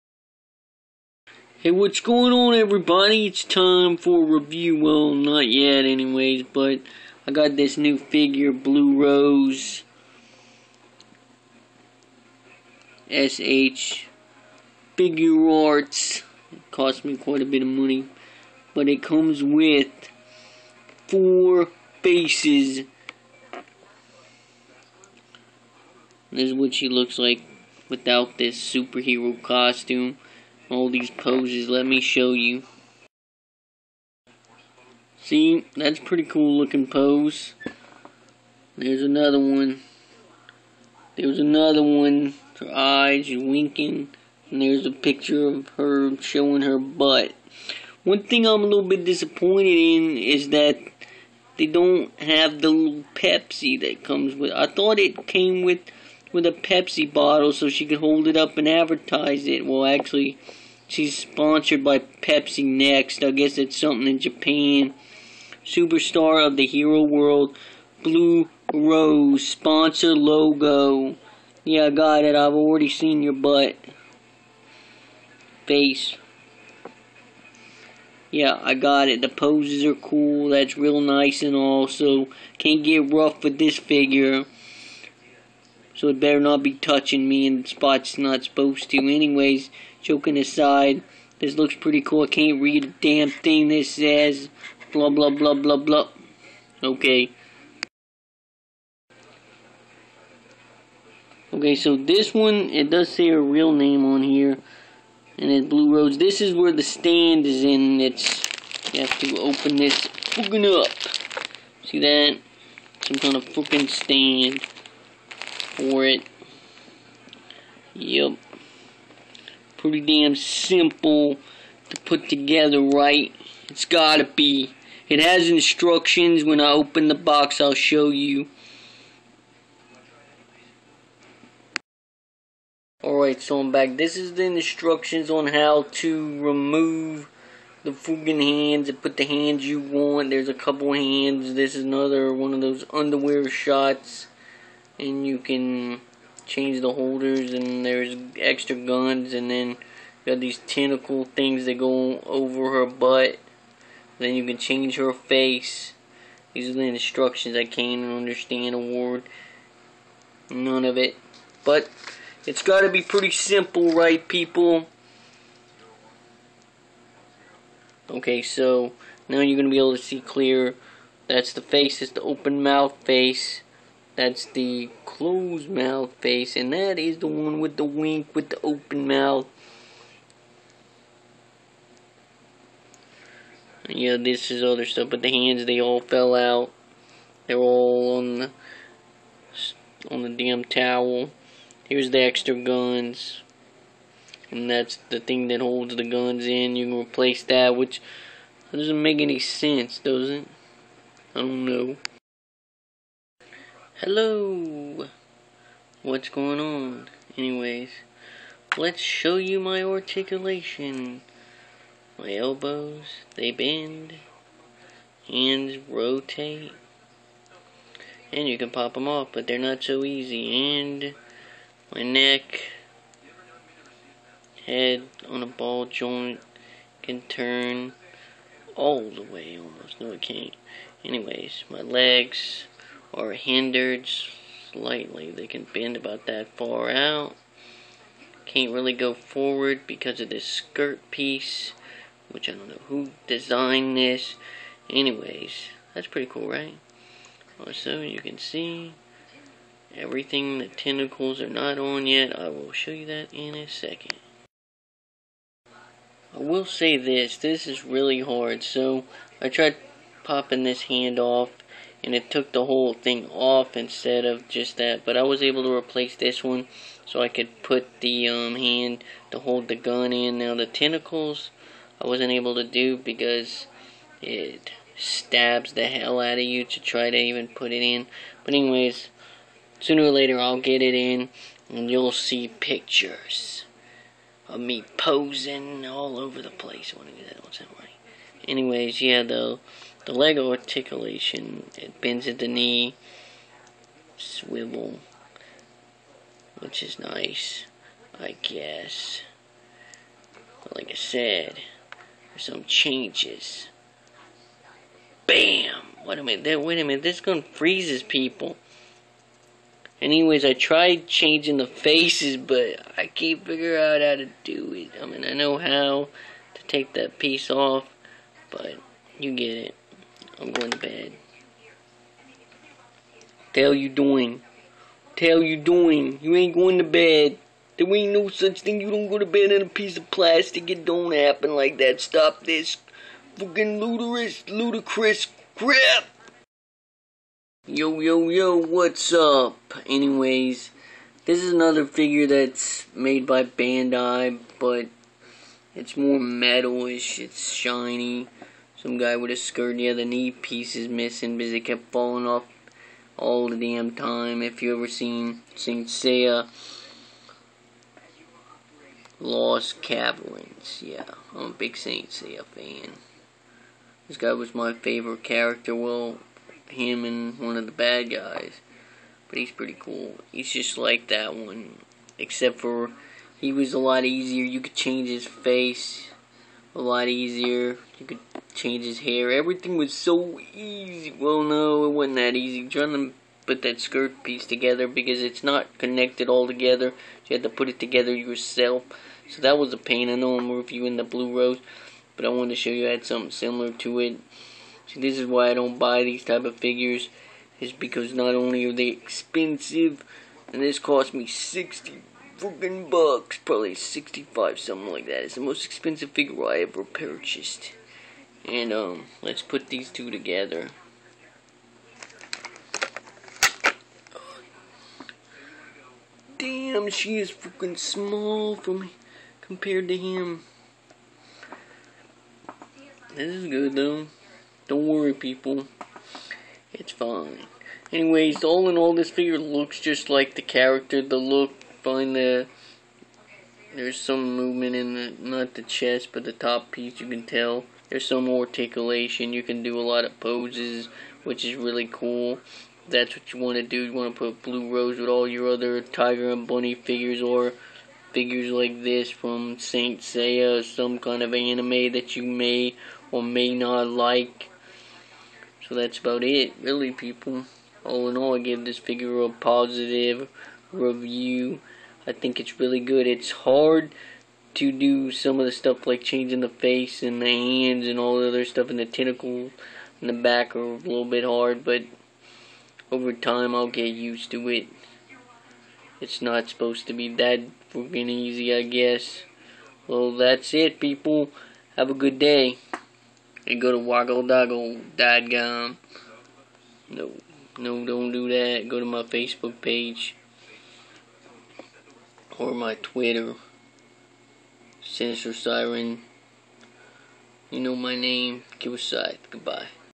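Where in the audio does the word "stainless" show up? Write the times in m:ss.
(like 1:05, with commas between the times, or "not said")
not said.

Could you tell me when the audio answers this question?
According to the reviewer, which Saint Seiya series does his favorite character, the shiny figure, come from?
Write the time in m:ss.
5:59.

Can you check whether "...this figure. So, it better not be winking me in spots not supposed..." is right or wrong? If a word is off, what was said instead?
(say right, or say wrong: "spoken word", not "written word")
wrong: "touching", not "winking".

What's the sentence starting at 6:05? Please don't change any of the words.
Well, him and one of the bad guys, but he's pretty cool.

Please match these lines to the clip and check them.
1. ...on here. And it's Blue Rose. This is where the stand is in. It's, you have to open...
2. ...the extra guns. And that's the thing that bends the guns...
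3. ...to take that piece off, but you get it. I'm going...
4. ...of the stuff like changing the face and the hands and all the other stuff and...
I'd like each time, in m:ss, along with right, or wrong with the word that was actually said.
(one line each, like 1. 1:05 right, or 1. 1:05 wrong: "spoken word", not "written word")
1. 1:44 right
2. 3:12 wrong: "holds", not "bends"
3. 5:16 right
4. 7:45 right.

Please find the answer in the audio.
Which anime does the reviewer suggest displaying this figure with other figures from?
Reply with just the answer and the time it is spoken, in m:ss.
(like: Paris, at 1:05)
Tiger and Bunny, at 7:25.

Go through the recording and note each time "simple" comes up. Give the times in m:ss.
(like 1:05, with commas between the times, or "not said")
2:00, 2:43.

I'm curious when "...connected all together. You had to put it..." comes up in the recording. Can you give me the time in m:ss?
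6:25.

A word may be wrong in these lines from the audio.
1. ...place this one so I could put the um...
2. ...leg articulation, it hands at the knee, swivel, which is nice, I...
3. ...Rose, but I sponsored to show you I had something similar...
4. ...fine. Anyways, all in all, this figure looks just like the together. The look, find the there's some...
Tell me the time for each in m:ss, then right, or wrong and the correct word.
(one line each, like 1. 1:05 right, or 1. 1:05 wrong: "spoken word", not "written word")
1. 4:25 wrong: "replace", not "place"
2. 4:50 wrong: "bends", not "hands"
3. 6:31 wrong: "wanted", not "sponsored"
4. 7:06 wrong: "character", not "together".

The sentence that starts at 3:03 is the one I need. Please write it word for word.
Yeah, this is other stuff, but the hands, they all fell out.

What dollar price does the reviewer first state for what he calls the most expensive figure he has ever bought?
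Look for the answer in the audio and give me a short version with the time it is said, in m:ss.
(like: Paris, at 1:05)
$60, at 6:41.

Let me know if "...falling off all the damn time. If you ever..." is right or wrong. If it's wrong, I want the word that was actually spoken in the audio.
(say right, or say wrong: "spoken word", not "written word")
right.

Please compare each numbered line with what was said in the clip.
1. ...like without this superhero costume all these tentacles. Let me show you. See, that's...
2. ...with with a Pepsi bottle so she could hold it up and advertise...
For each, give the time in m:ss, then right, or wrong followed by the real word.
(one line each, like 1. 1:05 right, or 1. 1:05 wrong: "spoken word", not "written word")
1. 0:27 wrong: "poses", not "tentacles"
2. 0:55 right.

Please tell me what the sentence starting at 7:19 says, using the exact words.
You can do a lot of poses, which is really cool.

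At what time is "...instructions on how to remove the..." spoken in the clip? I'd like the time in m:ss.
2:14.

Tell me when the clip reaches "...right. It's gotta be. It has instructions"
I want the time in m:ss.
2:02.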